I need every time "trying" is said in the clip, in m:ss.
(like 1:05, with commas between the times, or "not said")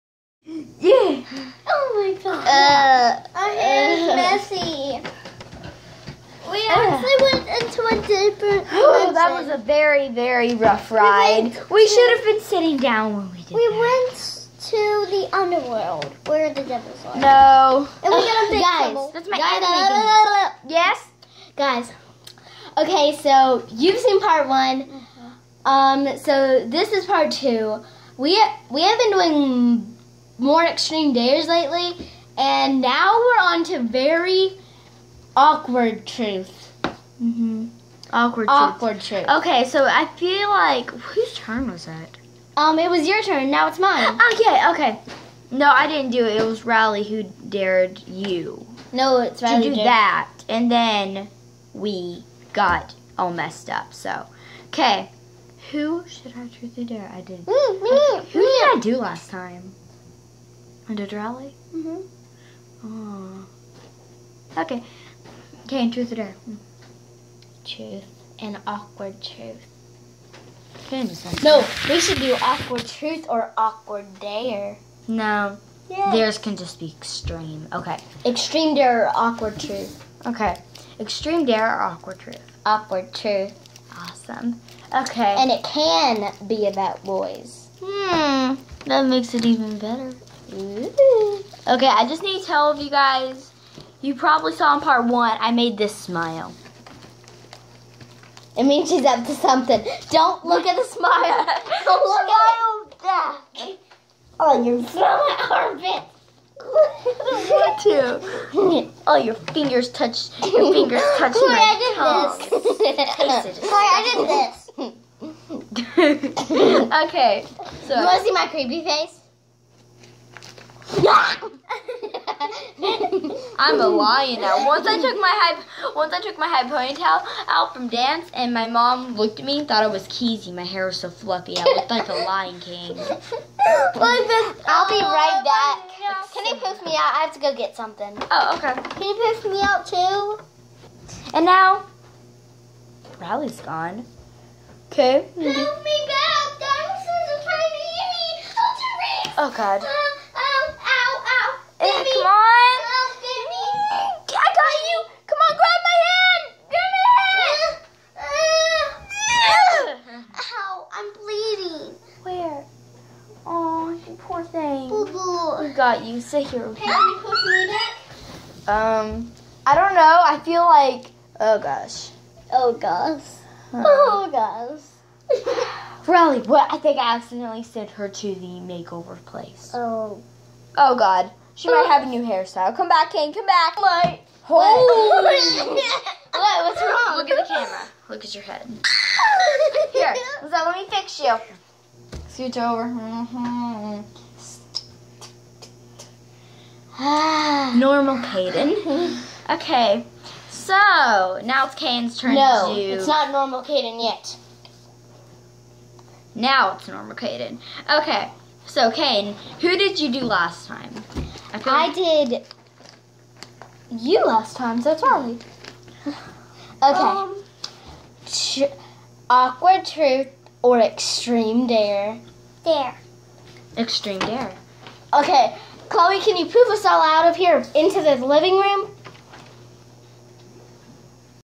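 2:27.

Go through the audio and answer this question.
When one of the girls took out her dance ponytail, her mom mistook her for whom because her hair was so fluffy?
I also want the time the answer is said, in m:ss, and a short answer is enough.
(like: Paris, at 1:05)
Keezy, at 2:10.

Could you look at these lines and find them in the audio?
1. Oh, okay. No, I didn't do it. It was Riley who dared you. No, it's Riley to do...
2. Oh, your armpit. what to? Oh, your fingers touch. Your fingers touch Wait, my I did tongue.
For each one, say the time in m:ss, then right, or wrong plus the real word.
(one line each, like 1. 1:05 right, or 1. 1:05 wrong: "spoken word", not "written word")
1. 0:44 right
2. 1:44 right.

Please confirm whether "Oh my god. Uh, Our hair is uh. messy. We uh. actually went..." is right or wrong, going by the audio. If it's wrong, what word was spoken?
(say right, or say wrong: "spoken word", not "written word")
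right.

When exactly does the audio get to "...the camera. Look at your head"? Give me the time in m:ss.
3:07.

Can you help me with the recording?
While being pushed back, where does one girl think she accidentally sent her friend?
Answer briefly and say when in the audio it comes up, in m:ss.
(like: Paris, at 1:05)
the makeover place, at 2:58.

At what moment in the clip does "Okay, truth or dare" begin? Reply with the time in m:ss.
1:05.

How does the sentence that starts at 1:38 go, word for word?
It means she's up to something.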